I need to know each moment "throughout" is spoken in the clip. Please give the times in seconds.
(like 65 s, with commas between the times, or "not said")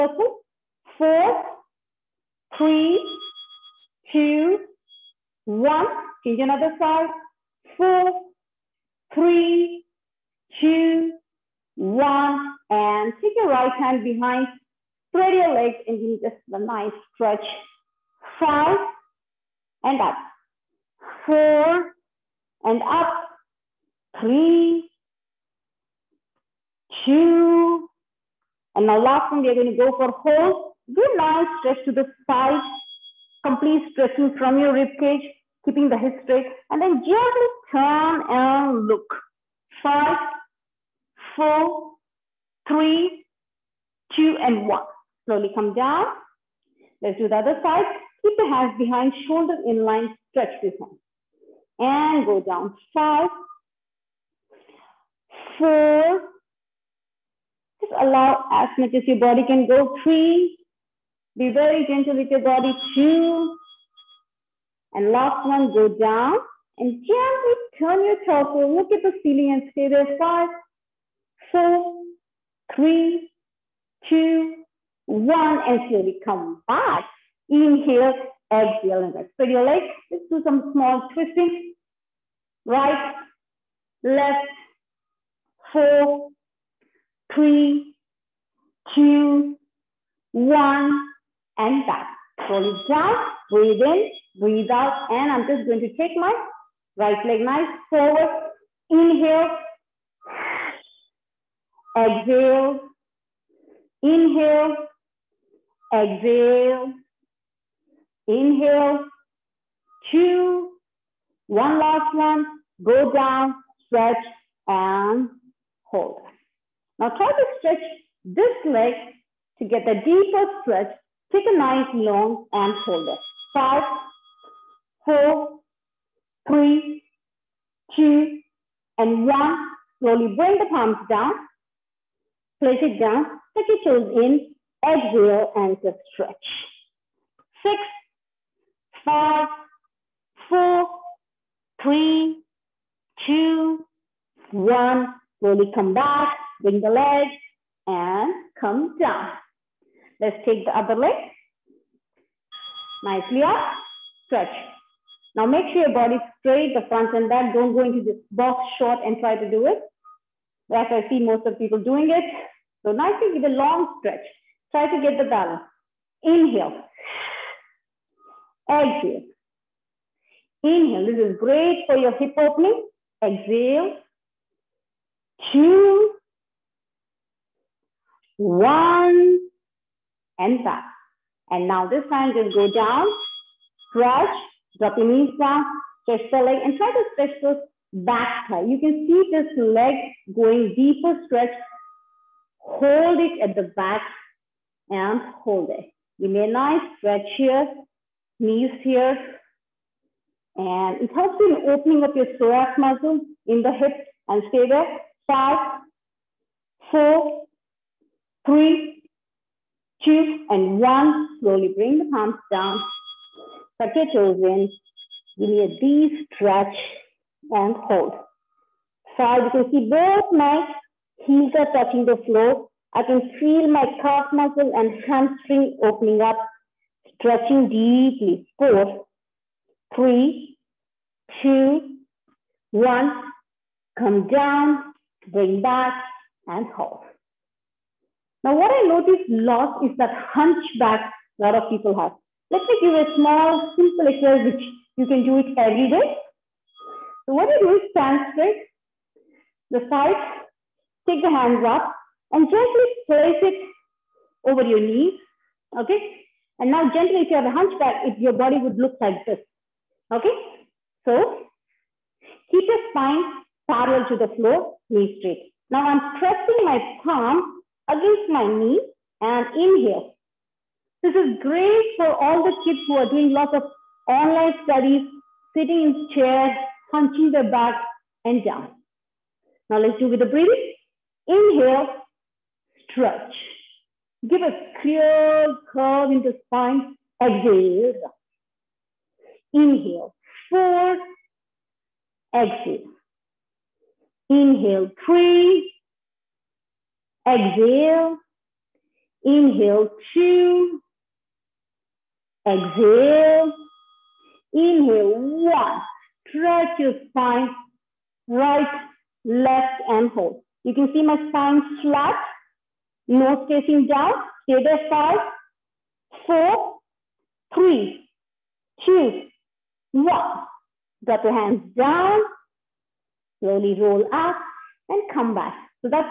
not said.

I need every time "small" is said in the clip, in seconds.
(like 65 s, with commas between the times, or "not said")
80 s, 243 s.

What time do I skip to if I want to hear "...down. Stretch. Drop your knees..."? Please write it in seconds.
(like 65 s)
182 s.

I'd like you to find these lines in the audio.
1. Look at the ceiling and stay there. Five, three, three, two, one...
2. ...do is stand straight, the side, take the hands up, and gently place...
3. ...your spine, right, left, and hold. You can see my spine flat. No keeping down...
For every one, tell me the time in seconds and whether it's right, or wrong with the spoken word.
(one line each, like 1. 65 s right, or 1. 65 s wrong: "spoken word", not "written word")
1. 68 s wrong: "four", not "three"
2. 247 s right
3. 306 s wrong: "spacing", not "keeping".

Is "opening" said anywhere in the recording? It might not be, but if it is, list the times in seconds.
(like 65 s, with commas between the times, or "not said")
172 s, 201 s, 225 s.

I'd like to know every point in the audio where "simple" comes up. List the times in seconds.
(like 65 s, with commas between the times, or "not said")
243 s.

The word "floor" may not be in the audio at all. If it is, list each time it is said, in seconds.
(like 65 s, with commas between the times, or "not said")
222 s, 264 s.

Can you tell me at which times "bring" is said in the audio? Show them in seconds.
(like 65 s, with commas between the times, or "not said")
130 s, 146 s, 211 s, 235 s.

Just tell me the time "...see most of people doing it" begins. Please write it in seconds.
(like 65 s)
161 s.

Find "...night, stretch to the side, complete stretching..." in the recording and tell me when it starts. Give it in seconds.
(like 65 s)
31 s.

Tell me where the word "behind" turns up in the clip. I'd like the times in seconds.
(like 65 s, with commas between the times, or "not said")
14 s, 48 s.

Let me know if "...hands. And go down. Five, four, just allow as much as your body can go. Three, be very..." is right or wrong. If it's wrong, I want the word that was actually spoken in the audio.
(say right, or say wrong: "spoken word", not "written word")
right.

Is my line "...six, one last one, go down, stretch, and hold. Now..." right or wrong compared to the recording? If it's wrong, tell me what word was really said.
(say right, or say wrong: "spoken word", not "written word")
wrong: "two", not "six".